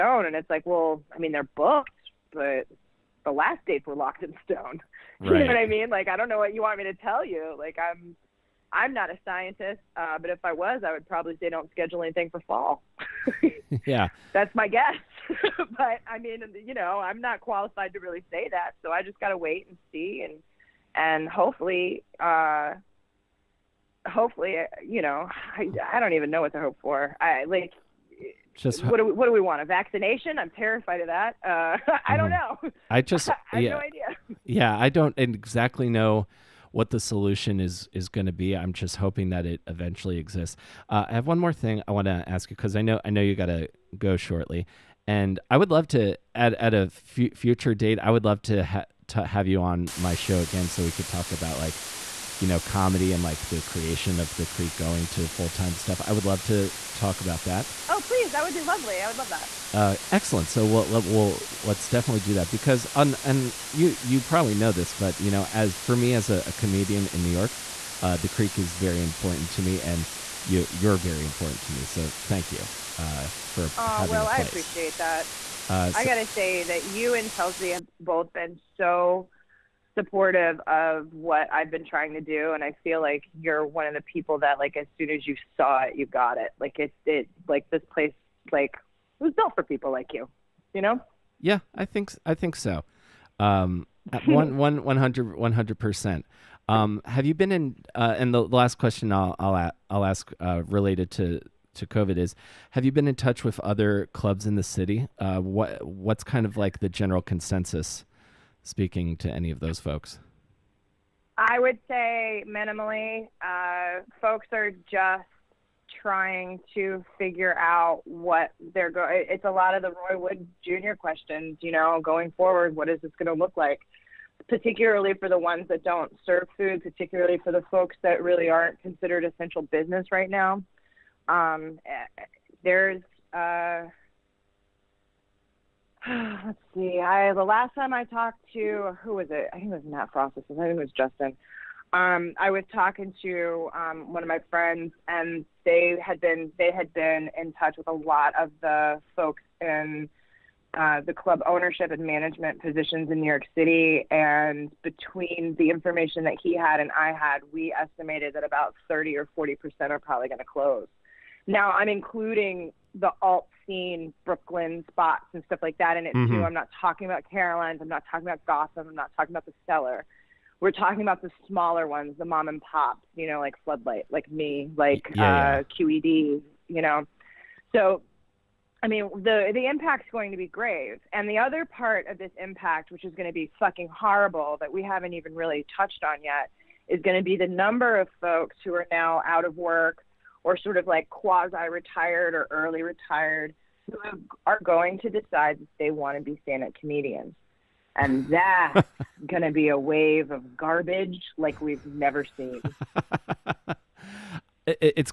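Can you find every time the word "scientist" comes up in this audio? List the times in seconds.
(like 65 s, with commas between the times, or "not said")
9 s.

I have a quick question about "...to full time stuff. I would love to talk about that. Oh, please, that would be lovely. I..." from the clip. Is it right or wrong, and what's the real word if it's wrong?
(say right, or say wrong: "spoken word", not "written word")
right.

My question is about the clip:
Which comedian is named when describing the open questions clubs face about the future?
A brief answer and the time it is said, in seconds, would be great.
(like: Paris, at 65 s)
Roy Wood Jr., at 119 s.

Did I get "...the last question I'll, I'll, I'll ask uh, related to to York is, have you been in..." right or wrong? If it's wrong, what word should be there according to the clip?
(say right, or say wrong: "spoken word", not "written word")
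wrong: "COVID", not "York".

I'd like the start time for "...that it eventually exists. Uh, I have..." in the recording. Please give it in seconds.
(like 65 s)
39 s.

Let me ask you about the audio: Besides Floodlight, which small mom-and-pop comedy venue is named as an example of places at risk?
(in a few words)
QED.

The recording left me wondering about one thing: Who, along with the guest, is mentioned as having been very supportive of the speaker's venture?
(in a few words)
Chelsea.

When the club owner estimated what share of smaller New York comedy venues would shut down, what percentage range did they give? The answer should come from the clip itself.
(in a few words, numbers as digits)
30 or 40 percent.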